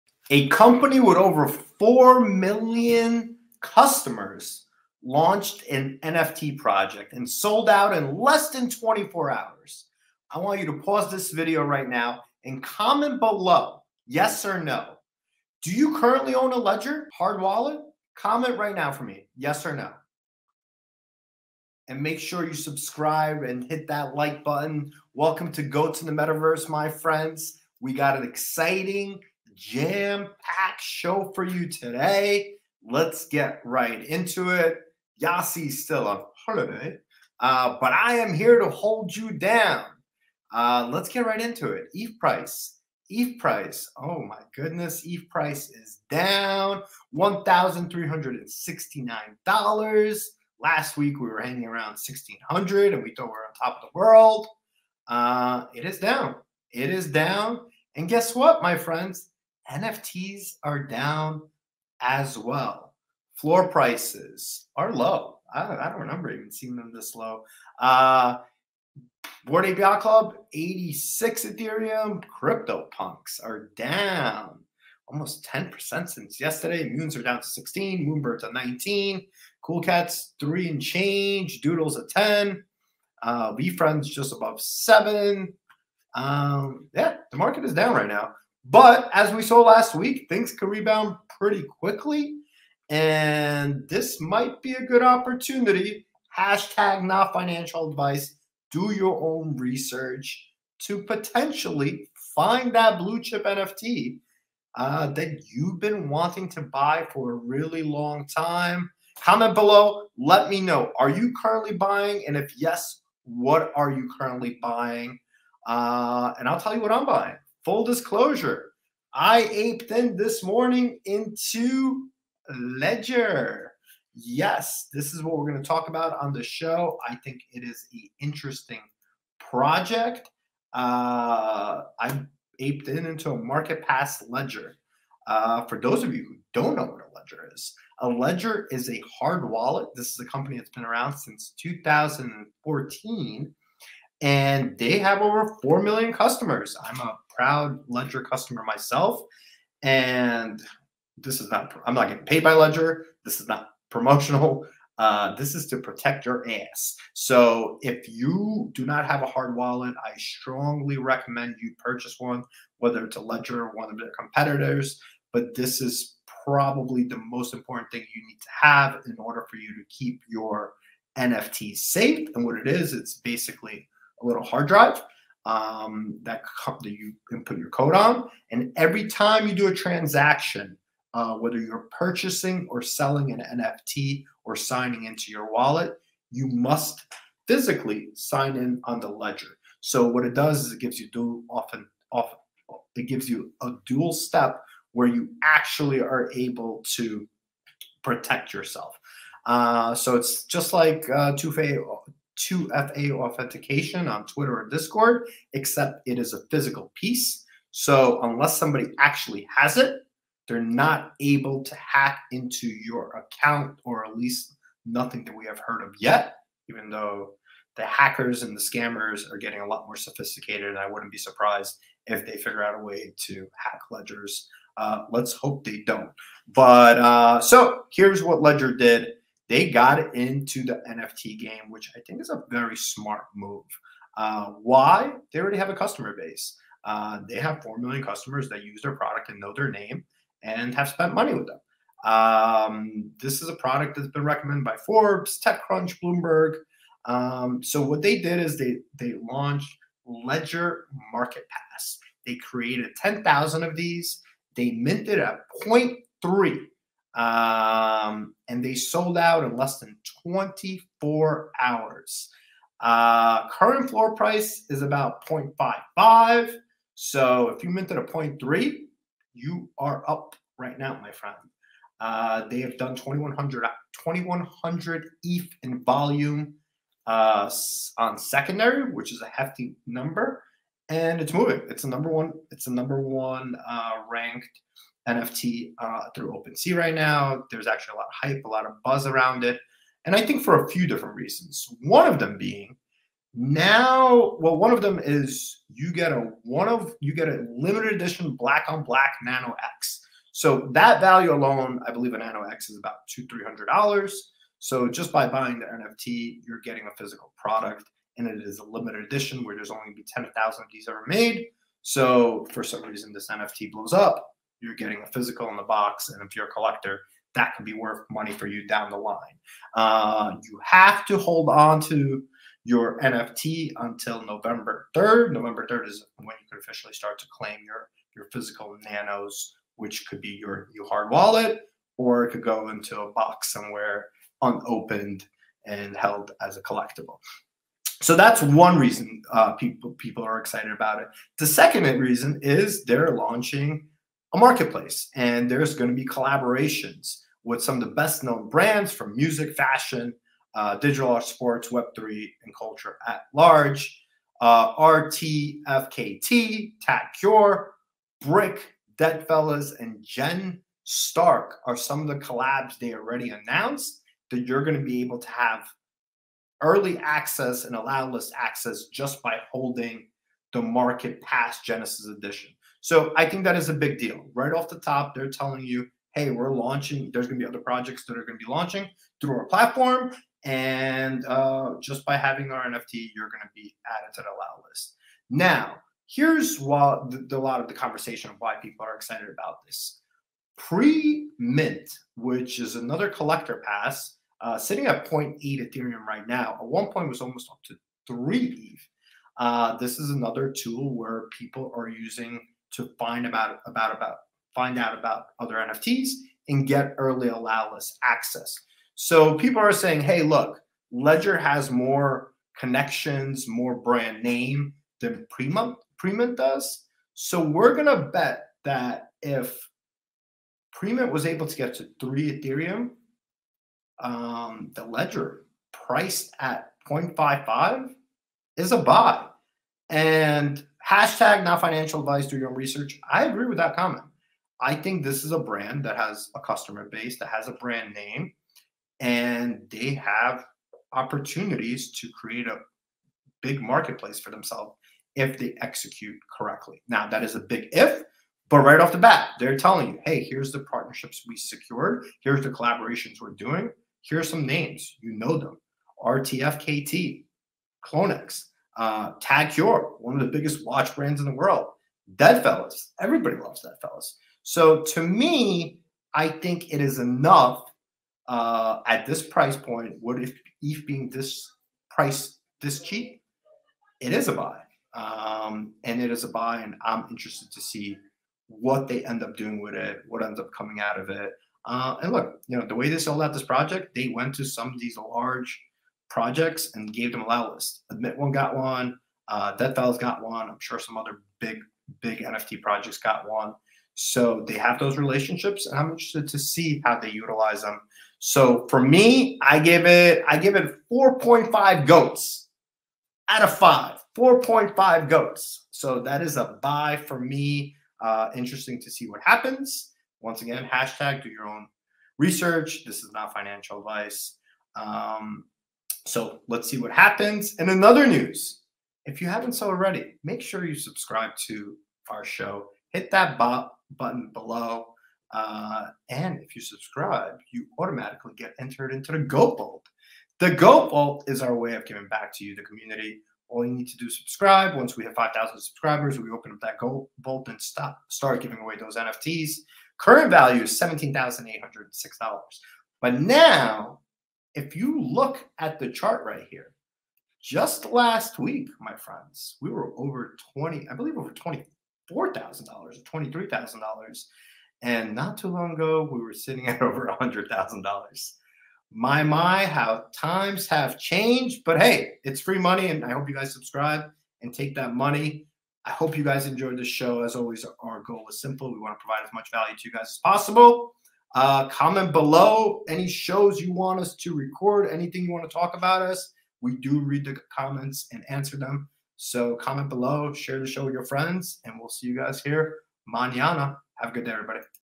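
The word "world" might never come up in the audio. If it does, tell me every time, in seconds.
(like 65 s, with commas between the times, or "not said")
53 s, 461 s.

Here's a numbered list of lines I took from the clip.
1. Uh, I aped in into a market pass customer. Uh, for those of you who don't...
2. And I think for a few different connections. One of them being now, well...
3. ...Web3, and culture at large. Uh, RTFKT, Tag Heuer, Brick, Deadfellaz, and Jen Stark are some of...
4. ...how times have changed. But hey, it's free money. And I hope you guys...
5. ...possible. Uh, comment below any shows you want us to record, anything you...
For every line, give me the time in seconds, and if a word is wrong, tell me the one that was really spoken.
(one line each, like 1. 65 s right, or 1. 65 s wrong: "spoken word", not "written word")
1. 130 s wrong: "ledger", not "customer"
2. 290 s wrong: "reasons", not "connections"
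3. 351 s right
4. 559 s right
5. 570 s right.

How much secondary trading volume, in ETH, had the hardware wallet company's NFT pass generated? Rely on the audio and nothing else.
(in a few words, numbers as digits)
2100 ETH.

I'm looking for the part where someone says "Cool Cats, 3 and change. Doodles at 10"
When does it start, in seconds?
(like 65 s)
79 s.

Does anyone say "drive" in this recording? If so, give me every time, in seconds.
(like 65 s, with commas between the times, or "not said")
174 s.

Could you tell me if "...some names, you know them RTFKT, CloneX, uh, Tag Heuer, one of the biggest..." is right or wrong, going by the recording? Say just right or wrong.
right.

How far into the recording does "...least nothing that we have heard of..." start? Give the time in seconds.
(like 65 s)
214 s.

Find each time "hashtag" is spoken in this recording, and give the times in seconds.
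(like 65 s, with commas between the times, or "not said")
96 s, 430 s, 510 s.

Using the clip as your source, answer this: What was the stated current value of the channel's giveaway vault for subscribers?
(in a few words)
$17,806.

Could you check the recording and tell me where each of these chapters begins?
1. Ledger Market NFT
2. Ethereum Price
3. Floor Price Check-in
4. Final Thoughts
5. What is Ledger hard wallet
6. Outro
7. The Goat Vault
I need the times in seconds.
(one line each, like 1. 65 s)
1. 248 s
2. 40 s
3. 60 s
4. 499 s
5. 125 s
6. 566 s
7. 520 s.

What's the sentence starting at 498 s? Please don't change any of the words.
So for me, I give it, I give it 4.5 goats out of five.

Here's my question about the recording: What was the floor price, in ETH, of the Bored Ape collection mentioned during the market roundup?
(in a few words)
86.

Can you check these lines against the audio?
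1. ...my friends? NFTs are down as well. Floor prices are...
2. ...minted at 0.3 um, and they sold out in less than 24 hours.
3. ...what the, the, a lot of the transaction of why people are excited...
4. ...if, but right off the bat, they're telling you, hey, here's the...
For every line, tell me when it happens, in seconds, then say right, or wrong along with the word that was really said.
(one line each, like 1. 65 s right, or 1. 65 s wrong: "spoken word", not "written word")
1. 58 s right
2. 254 s right
3. 386 s wrong: "conversation", not "transaction"
4. 447 s right.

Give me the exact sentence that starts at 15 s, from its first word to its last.
Do you currently own a ledger, hard wallet?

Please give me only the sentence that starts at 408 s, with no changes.
So people are saying, hey, look, Ledger has more connections, more brand name than Prima Premint does.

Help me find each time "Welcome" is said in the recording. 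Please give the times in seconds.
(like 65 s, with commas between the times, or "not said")
25 s.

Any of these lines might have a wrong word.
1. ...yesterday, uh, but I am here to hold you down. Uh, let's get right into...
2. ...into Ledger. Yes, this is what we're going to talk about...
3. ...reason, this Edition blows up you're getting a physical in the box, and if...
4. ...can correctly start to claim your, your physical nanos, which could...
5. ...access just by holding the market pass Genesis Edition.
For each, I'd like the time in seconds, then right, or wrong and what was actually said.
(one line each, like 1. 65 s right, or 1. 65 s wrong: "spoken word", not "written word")
1. 36 s wrong: "holiday", not "yesterday"
2. 121 s right
3. 312 s wrong: "NFT", not "Edition"
4. 326 s wrong: "officially", not "correctly"
5. 368 s right.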